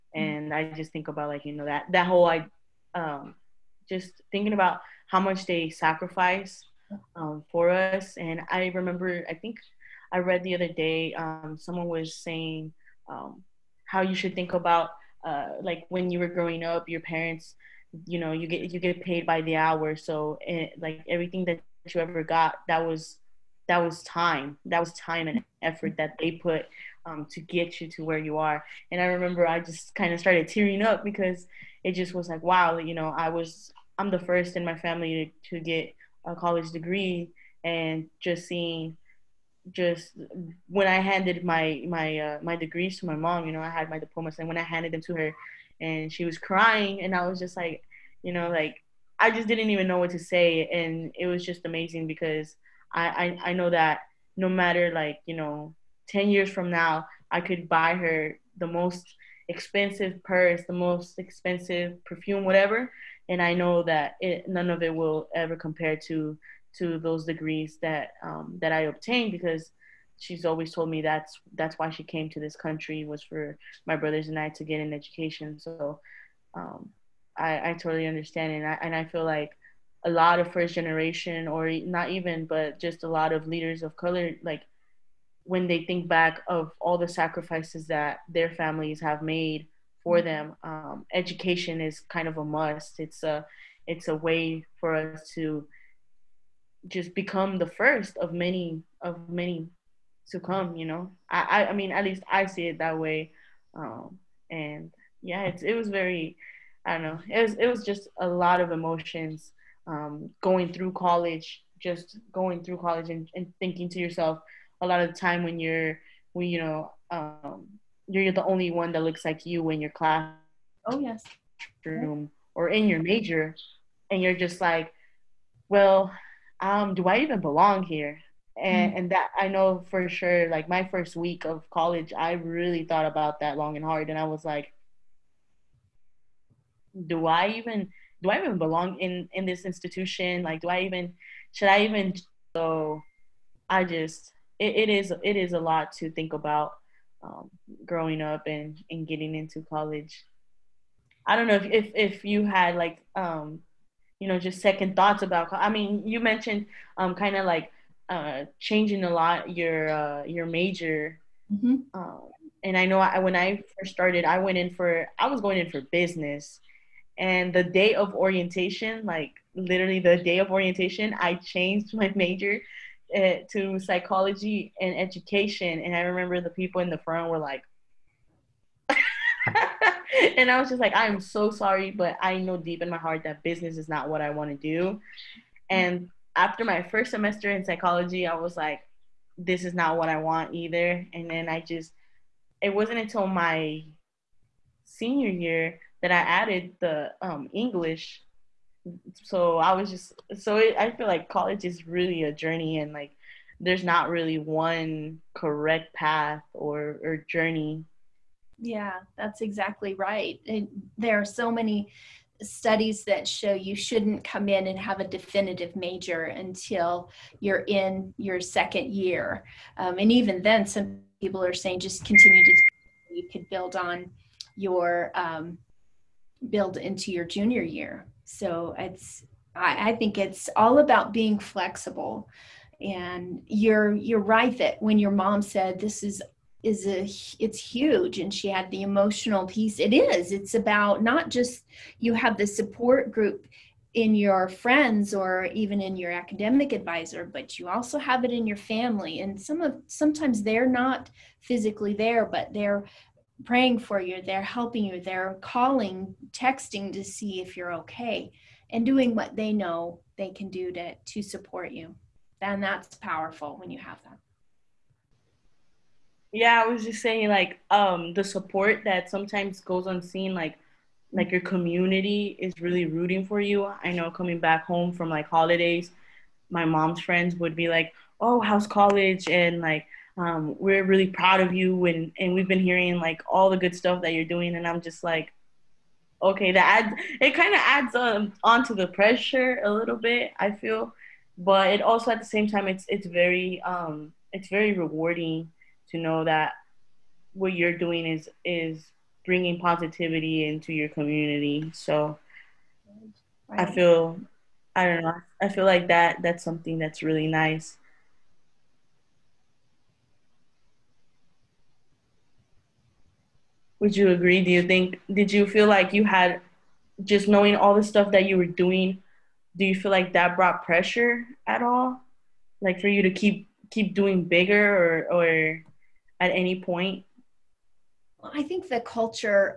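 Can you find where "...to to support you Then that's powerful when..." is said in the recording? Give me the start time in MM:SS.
04:20.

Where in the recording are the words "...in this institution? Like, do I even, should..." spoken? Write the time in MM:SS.
02:19.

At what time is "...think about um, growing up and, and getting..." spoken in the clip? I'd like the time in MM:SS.
02:26.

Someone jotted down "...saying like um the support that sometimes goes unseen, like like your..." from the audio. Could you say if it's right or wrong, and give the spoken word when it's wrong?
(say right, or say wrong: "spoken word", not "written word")
right.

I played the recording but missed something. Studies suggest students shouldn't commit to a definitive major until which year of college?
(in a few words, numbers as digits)
Second year.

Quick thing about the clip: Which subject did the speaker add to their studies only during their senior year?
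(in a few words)
English.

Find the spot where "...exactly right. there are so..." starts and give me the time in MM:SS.
03:29.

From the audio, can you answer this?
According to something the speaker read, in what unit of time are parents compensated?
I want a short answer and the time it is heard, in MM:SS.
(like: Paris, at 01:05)
By the hour, at 00:19.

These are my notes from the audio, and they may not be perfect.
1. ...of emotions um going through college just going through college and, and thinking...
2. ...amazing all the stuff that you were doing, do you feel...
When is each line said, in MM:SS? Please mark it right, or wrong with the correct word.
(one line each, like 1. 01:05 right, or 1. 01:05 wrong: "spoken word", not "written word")
1. 01:48 right
2. 05:17 wrong: "knowing", not "amazing".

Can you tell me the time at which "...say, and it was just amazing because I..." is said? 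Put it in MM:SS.
00:50.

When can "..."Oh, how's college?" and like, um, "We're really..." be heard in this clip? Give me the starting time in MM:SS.
04:38.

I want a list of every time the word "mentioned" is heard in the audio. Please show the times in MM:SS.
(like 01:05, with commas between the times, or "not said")
02:36.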